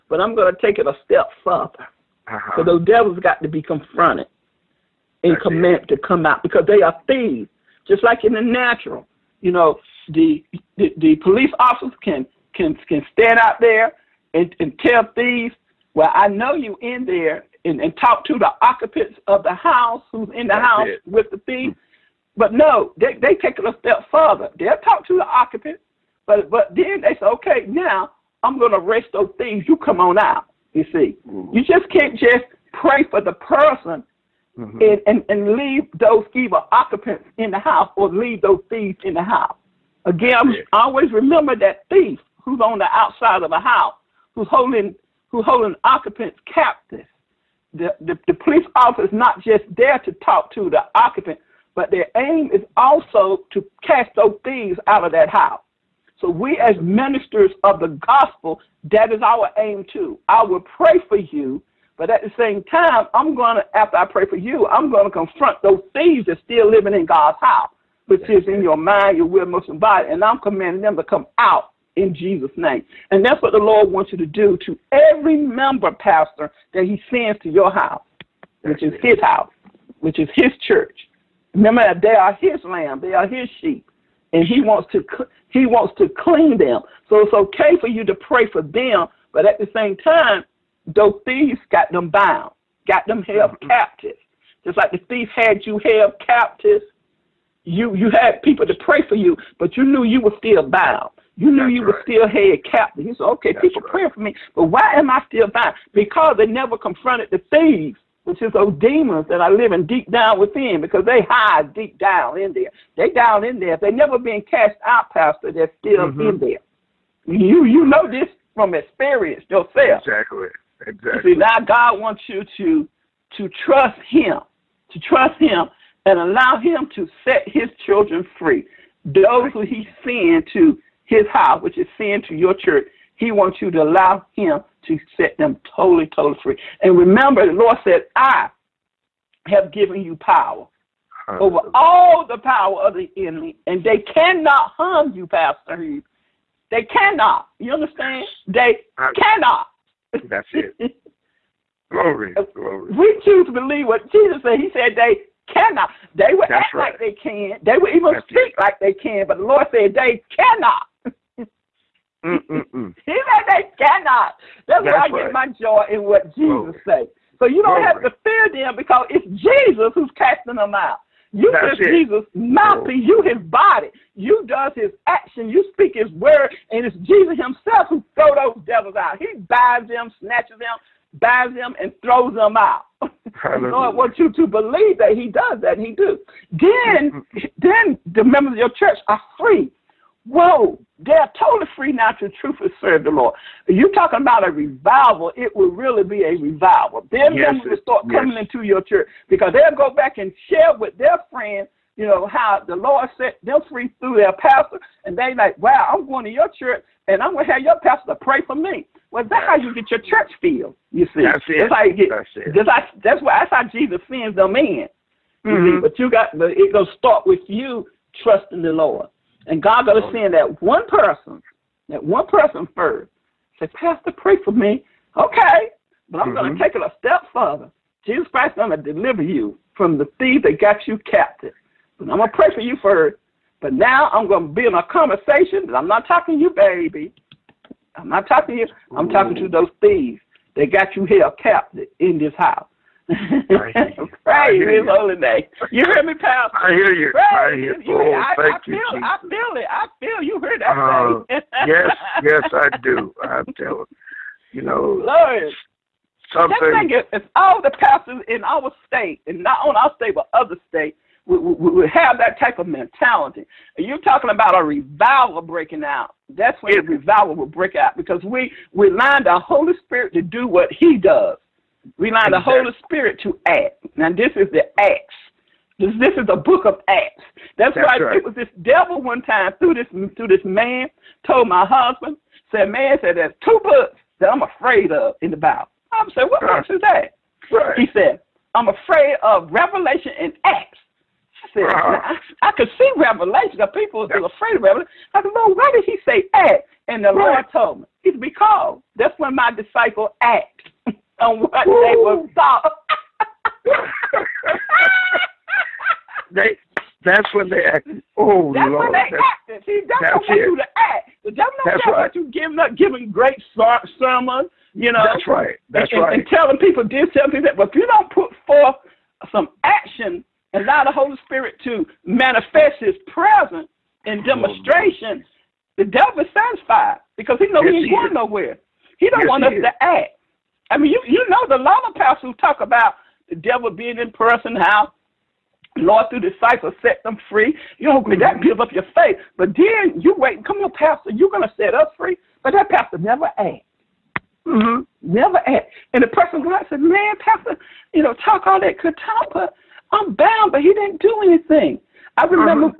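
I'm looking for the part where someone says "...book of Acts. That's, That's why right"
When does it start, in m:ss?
4:36.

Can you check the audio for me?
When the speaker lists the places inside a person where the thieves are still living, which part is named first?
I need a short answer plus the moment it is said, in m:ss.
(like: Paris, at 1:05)
Your mind, at 1:08.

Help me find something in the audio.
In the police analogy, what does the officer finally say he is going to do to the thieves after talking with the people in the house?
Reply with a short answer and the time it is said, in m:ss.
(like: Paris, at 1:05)
Arrest those things, at 0:28.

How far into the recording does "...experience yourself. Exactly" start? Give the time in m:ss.
1:58.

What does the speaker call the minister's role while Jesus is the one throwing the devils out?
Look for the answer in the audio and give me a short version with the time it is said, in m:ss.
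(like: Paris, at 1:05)
Jesus' mouthpiece, at 2:51.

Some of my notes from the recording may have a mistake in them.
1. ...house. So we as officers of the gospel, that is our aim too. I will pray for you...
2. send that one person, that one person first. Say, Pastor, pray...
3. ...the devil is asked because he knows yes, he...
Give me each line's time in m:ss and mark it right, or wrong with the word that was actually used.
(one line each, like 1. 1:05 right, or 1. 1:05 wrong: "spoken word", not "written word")
1. 0:55 wrong: "ministers", not "officers"
2. 3:40 right
3. 5:25 wrong: "satisfied", not "asked".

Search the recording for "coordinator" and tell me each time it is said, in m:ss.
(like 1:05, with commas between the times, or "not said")
not said.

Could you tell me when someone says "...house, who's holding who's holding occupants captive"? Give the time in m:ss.
0:43.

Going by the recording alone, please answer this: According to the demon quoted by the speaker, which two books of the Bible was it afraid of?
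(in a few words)
Revelation and Acts.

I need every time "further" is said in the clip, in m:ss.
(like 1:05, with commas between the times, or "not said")
0:01, 0:24, 3:47.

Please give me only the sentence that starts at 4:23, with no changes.
And you're talking about a revival breaking out.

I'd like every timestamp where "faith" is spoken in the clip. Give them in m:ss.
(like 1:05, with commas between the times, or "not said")
5:38.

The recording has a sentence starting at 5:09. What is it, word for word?
See, that's, that's what you to act.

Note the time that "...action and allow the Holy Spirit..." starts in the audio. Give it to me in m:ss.
5:19.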